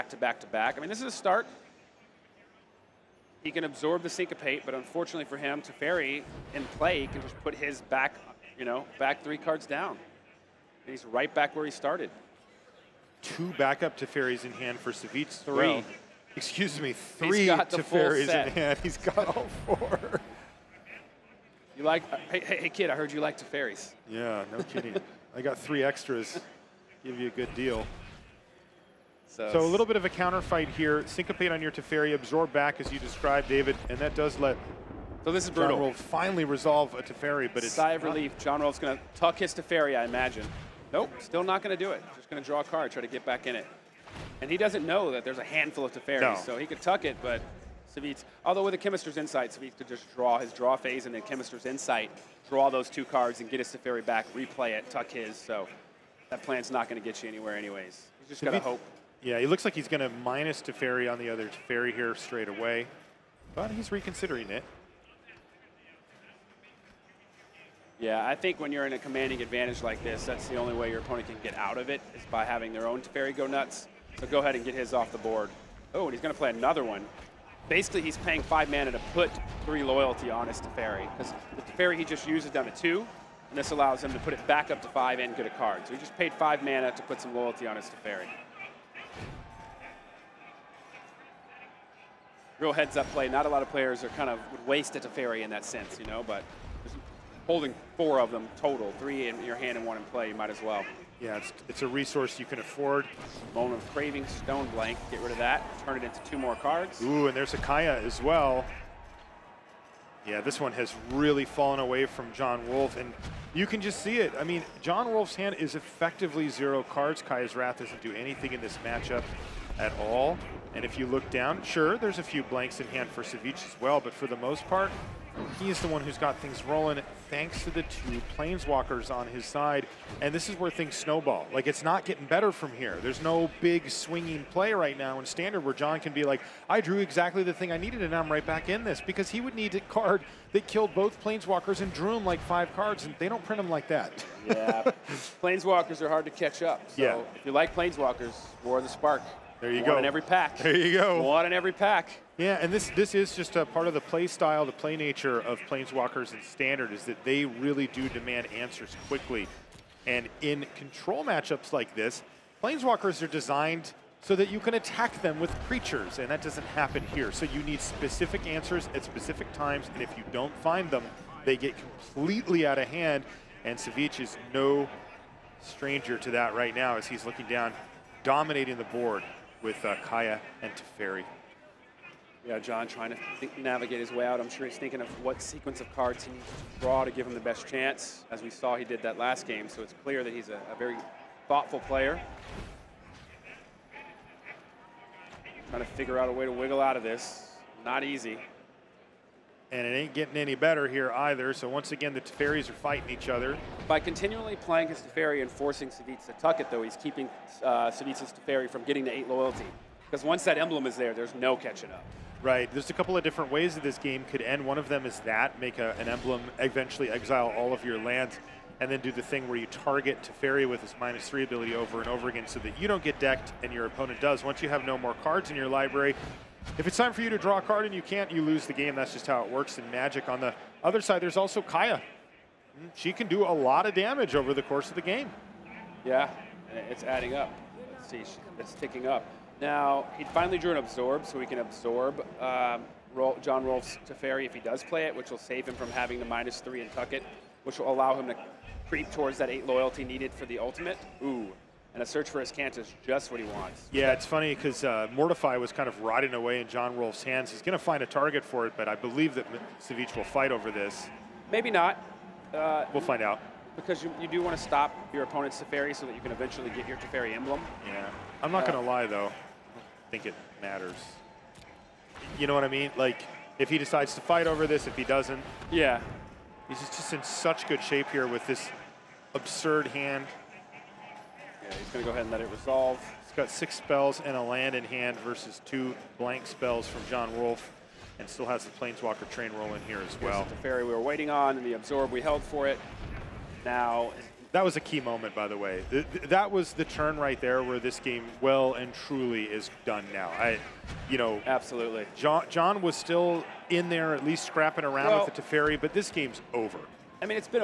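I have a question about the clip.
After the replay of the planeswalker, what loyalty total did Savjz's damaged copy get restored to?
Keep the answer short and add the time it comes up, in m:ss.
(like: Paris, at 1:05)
5, at 1:24.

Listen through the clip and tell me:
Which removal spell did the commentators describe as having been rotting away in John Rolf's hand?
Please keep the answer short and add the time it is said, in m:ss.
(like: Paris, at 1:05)
Mortify, at 4:15.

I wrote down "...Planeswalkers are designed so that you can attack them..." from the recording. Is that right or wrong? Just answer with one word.
right.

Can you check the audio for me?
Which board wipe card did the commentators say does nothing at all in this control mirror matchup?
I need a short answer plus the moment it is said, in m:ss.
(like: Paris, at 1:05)
Kaya's Wrath, at 1:57.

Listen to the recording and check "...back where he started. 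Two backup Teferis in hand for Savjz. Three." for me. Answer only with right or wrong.
right.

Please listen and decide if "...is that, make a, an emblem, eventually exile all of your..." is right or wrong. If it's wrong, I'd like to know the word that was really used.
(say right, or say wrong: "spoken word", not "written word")
right.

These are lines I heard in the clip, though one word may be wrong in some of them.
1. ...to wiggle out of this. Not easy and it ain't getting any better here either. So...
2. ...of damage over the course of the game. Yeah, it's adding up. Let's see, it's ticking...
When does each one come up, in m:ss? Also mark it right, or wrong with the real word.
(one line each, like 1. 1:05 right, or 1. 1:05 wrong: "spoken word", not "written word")
1. 3:16 right
2. 3:53 right.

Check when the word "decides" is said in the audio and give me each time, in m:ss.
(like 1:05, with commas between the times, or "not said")
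4:33.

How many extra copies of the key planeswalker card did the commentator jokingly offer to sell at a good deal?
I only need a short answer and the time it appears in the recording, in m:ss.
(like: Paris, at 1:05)
3, at 0:25.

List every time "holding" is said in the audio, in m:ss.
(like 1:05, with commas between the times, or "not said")
1:37.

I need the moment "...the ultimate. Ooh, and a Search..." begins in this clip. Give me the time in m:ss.
4:10.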